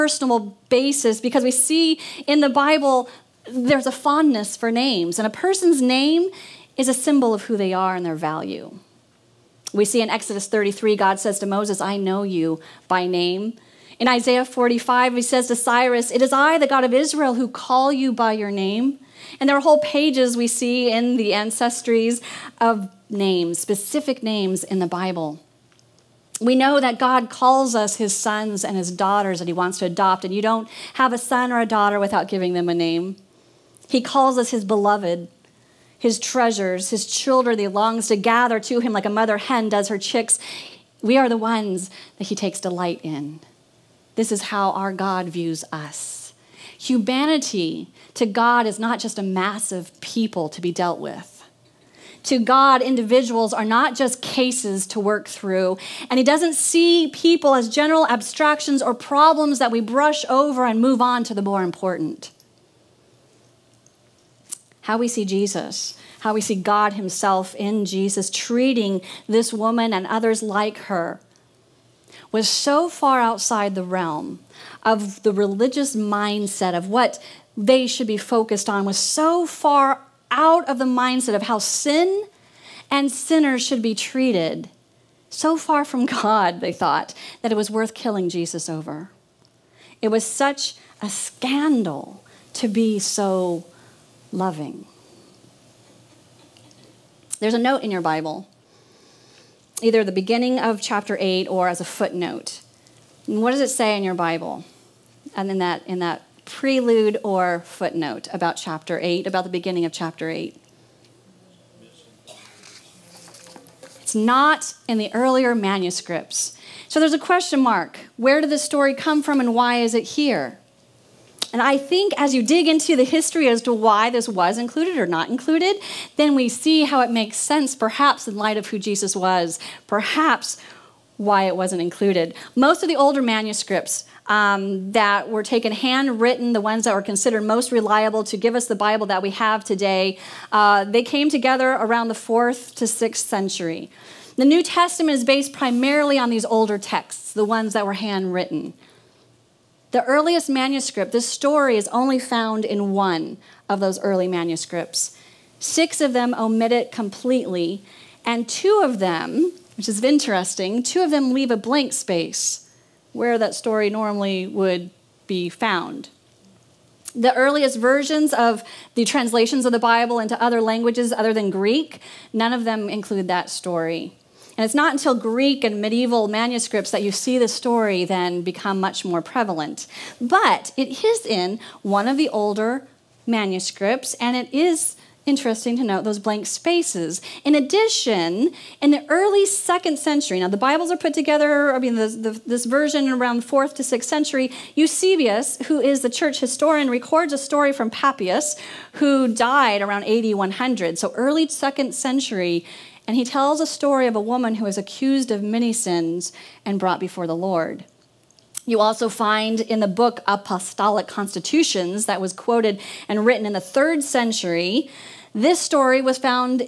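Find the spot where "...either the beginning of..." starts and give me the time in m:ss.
1:39.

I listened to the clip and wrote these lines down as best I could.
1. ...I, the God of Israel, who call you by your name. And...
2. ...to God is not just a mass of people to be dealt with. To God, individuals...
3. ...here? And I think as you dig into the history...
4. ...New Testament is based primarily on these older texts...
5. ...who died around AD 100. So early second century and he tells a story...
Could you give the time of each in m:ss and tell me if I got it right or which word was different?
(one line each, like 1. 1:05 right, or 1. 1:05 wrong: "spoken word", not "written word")
1. 0:16 right
2. 0:48 right
3. 2:00 right
4. 2:24 right
5. 3:18 right.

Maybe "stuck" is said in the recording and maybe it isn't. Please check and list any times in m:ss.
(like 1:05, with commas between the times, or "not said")
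not said.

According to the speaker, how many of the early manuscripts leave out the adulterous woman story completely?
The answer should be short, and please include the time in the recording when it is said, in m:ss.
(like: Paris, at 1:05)
6, at 2:35.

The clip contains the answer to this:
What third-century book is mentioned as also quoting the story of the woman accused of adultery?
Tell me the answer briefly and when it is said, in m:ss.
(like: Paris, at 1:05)
Apostolic Constitutions, at 3:30.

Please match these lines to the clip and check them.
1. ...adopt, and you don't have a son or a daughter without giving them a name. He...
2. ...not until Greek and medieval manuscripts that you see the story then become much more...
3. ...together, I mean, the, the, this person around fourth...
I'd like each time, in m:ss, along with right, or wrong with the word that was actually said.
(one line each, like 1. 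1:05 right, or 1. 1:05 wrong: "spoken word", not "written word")
1. 0:29 right
2. 2:54 right
3. 3:11 wrong: "version", not "person".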